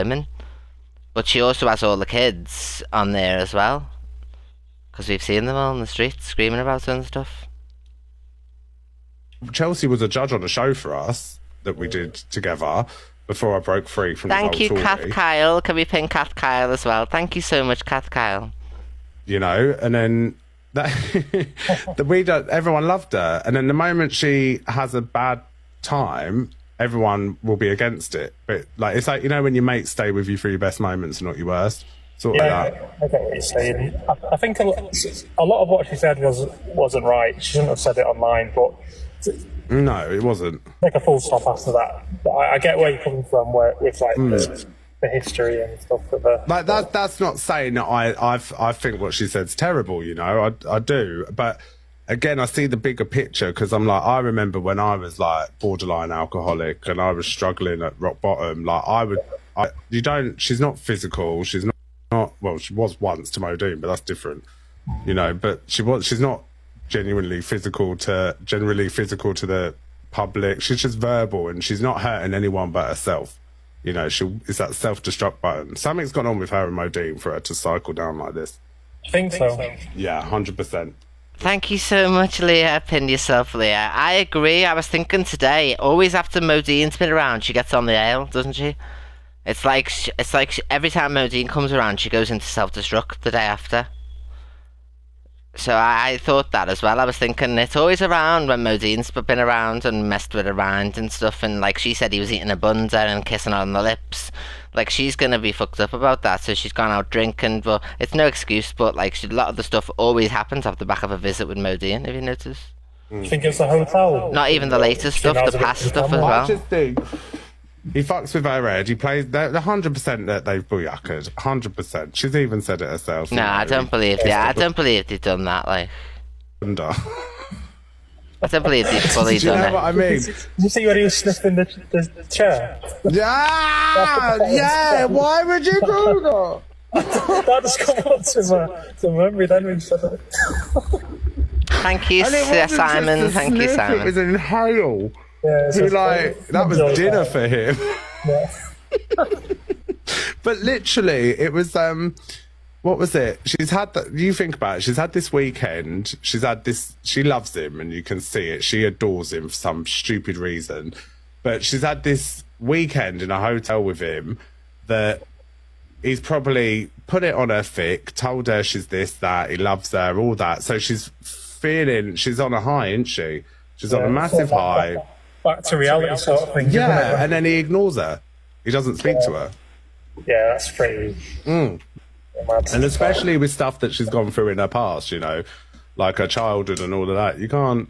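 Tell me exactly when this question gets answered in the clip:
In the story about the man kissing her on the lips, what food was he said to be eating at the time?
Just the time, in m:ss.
1:42.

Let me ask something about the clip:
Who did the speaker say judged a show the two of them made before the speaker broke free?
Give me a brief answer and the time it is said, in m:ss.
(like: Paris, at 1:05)
Chelsea, at 0:09.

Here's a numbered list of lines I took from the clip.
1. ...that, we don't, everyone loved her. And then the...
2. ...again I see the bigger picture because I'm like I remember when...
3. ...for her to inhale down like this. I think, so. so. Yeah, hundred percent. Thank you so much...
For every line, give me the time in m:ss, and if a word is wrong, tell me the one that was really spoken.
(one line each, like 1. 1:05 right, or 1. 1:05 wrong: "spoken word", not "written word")
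1. 0:20 right
2. 0:52 right
3. 1:17 wrong: "cycle", not "inhale".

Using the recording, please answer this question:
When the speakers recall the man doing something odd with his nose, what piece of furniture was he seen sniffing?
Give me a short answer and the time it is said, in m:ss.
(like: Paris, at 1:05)
The chair, at 2:12.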